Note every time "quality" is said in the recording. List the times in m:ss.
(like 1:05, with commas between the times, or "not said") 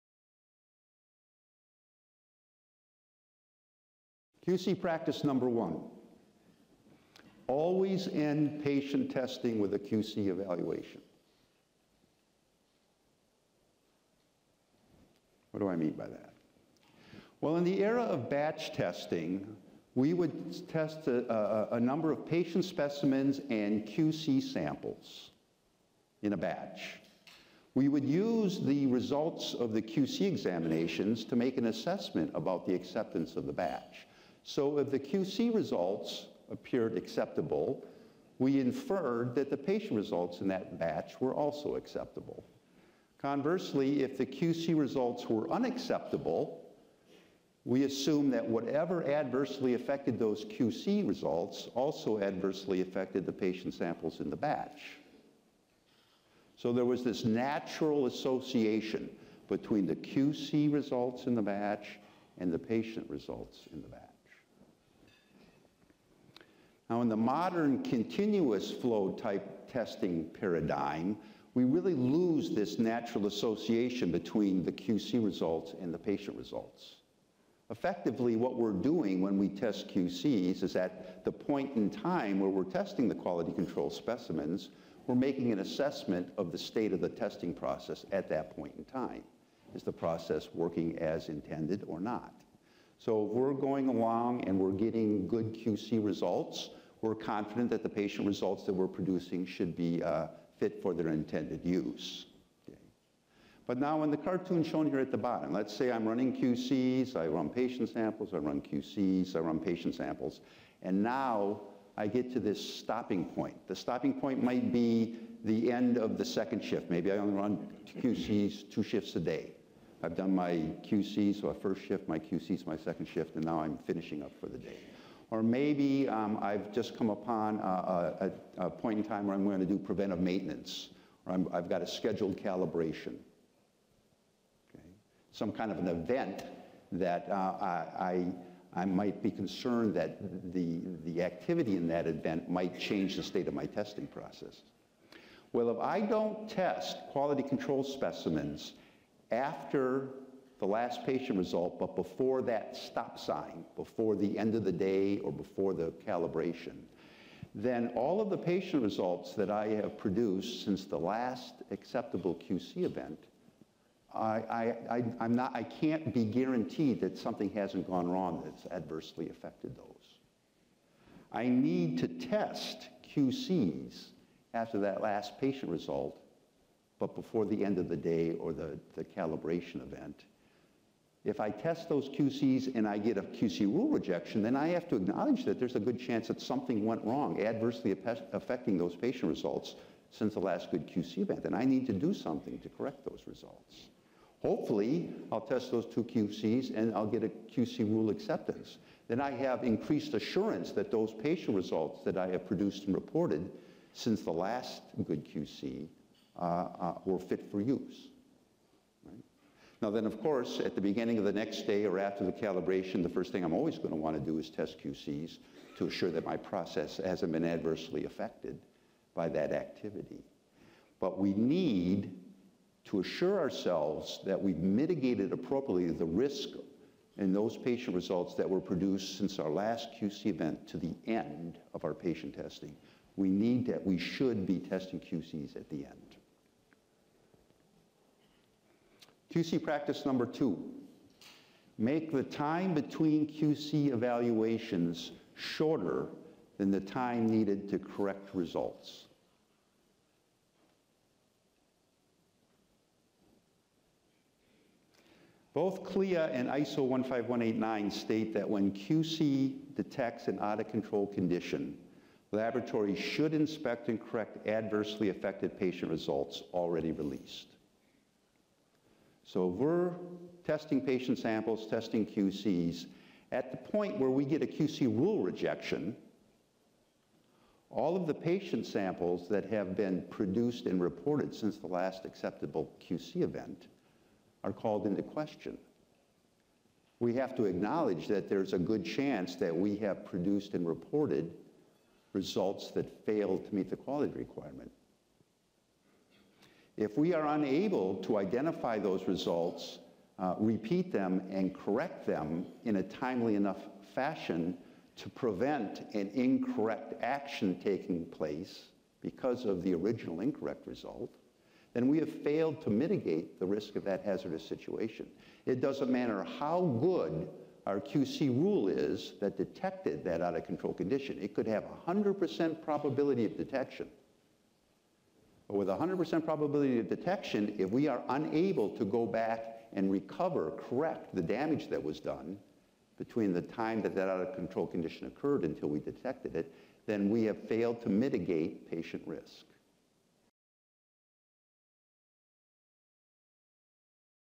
1:23, 2:27, 4:53.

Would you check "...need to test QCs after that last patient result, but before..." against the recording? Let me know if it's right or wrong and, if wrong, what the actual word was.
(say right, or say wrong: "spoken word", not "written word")
right.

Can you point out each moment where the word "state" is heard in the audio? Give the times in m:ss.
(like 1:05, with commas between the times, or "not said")
1:26, 2:23, 4:17.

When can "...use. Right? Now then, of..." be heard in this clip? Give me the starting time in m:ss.
3:27.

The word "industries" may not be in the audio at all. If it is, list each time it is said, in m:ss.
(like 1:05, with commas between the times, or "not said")
not said.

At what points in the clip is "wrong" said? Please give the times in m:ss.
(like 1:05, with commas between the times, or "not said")
2:48, 3:07.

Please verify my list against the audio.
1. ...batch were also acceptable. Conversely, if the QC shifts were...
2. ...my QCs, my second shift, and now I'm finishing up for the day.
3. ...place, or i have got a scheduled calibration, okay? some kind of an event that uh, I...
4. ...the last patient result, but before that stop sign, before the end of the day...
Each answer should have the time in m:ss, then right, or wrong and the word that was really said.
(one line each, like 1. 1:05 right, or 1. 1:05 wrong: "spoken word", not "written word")
1. 0:40 wrong: "results", not "shifts"
2. 2:02 right
3. 2:10 wrong: "maintenance", not "place"
4. 2:30 right.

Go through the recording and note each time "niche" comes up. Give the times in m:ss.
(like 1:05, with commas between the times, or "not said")
not said.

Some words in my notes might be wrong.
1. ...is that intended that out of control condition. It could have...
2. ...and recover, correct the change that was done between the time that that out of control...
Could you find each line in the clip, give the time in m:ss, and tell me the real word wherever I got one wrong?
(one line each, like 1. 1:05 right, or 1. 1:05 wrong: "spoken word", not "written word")
1. 5:18 wrong: "detected", not "intended"
2. 5:29 wrong: "damage", not "change".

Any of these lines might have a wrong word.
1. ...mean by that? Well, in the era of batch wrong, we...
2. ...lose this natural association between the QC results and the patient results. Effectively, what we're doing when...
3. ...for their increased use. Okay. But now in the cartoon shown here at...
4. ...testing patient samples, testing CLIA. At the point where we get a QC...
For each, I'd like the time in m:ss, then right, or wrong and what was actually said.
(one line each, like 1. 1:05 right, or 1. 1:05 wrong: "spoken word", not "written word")
1. 0:15 wrong: "testing", not "wrong"
2. 1:11 right
3. 1:40 wrong: "intended", not "increased"
4. 4:30 wrong: "QCs", not "CLIA".